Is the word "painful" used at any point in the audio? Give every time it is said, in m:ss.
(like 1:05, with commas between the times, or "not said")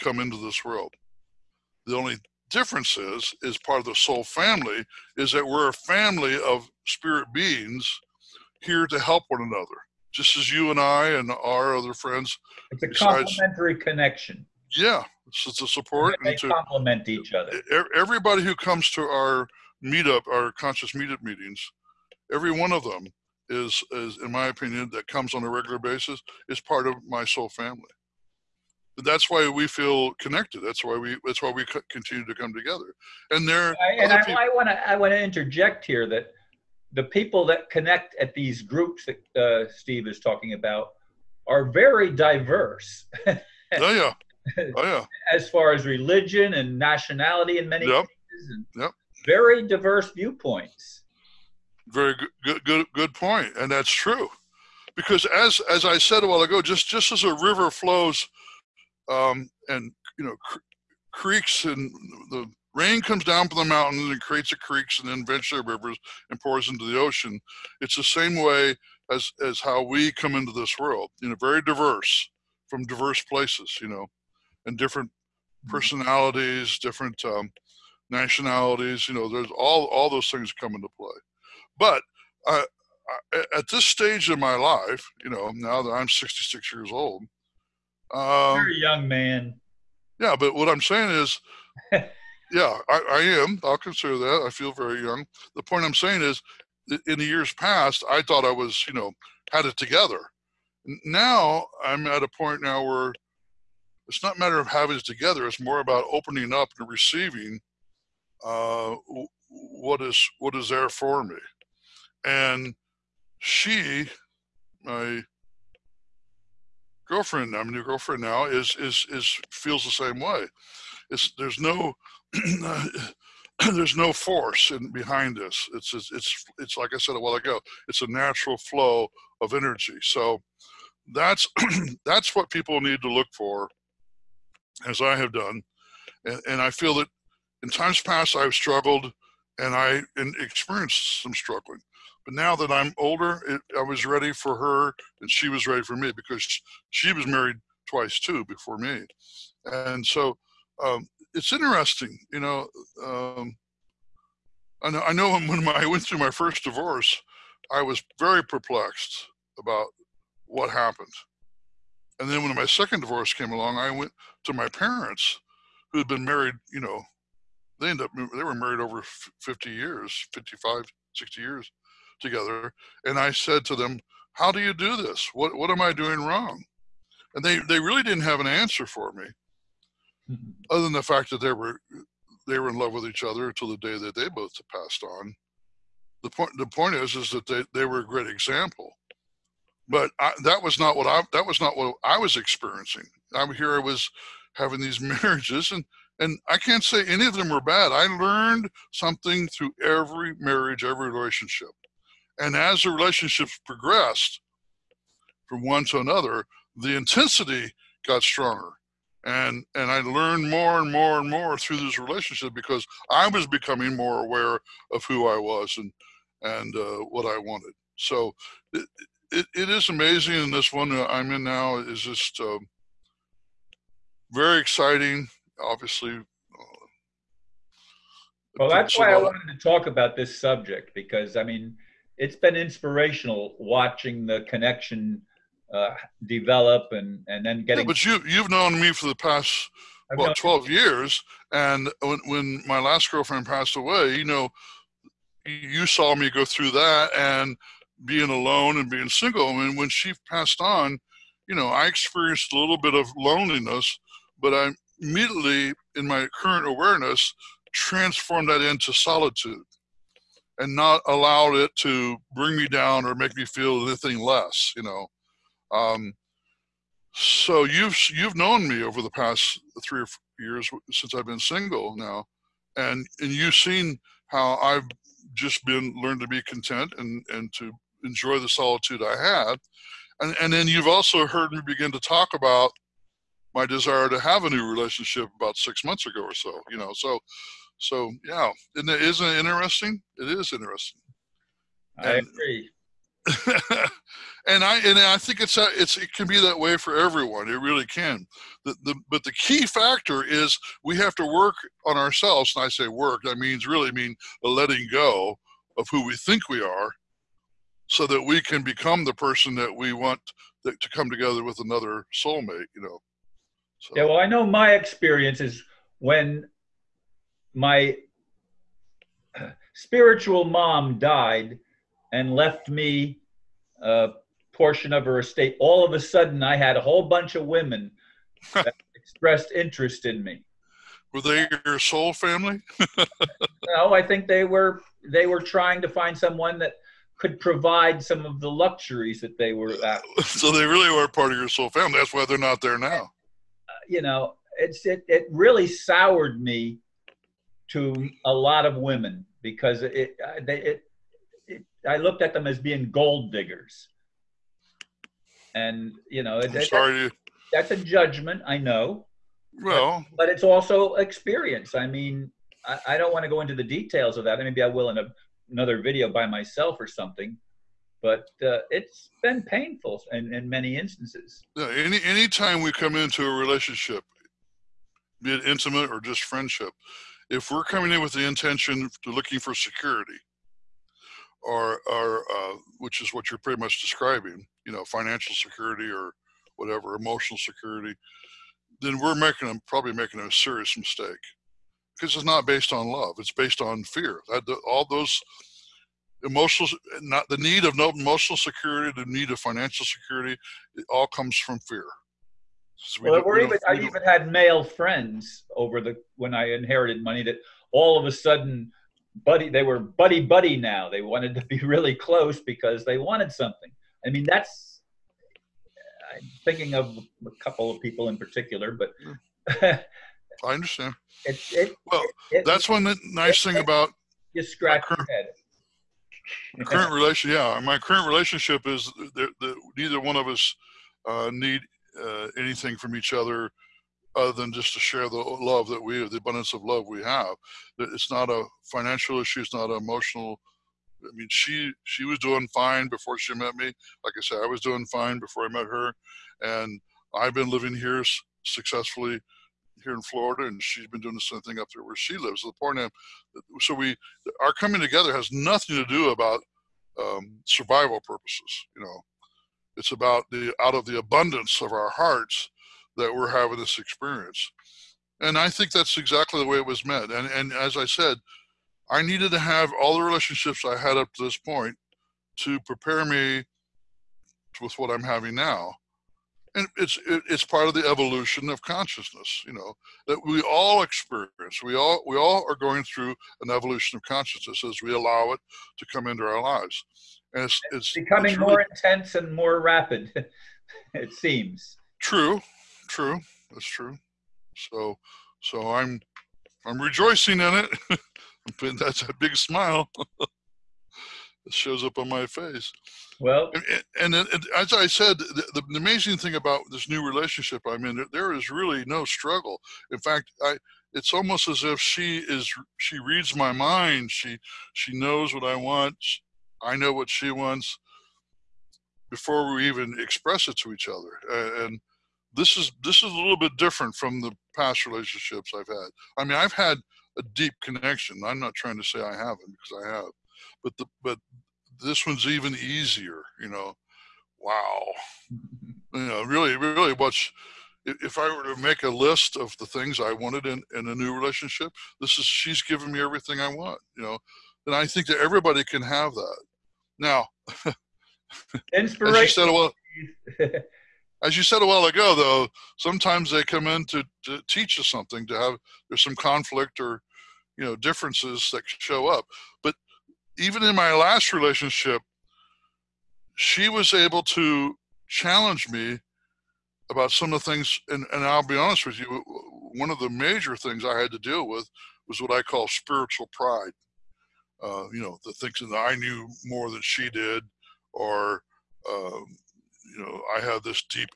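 6:09.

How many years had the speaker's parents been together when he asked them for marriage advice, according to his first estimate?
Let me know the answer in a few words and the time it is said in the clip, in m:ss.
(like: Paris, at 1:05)
50, at 2:48.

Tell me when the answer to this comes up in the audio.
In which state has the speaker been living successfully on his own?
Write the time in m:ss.
7:30.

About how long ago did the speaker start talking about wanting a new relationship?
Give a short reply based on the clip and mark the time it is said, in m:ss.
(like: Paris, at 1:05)
6 months, at 4:45.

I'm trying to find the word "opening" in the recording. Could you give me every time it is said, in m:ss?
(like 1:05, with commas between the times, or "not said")
1:46.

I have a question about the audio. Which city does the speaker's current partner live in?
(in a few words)
Portland.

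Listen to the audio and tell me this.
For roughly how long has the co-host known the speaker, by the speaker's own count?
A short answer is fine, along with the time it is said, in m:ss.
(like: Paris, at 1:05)
12 years, at 4:00.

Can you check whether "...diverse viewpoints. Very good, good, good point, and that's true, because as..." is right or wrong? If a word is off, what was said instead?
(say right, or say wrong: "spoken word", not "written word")
right.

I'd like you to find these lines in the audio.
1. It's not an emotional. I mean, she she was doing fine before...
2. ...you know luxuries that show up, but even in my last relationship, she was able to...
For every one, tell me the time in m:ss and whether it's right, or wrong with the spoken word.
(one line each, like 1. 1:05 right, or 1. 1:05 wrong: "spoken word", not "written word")
1. 7:19 right
2. 9:17 wrong: "differences", not "luxuries".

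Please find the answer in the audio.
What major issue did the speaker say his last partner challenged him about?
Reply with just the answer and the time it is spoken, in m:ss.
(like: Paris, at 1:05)
Spiritual pride, at 9:32.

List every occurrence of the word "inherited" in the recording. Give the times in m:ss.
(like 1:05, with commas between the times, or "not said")
6:46.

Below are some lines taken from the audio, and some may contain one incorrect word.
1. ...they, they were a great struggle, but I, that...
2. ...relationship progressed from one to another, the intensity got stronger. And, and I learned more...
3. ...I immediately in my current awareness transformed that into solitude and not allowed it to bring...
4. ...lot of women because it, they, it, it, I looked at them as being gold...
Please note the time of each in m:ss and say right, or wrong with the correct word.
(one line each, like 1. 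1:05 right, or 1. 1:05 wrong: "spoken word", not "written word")
1. 3:07 wrong: "example", not "struggle"
2. 3:22 right
3. 4:14 right
4. 5:48 right.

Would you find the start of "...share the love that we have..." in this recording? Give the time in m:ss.
7:14.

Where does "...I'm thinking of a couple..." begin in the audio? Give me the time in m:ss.
6:56.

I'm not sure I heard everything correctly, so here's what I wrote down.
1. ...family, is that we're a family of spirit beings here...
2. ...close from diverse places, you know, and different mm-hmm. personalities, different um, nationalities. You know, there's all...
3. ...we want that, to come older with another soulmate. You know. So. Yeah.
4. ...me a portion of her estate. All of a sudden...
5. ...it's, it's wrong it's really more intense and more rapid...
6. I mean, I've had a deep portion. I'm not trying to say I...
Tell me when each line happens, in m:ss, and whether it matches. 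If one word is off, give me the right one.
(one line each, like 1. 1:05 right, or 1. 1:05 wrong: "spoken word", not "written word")
1. 0:04 right
2. 1:11 wrong: "diverse", not "close"
3. 5:09 wrong: "together", not "older"
4. 5:22 right
5. 8:07 wrong: "becoming", not "wrong"
6. 8:46 wrong: "connection", not "portion".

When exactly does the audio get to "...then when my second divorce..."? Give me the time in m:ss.
2:42.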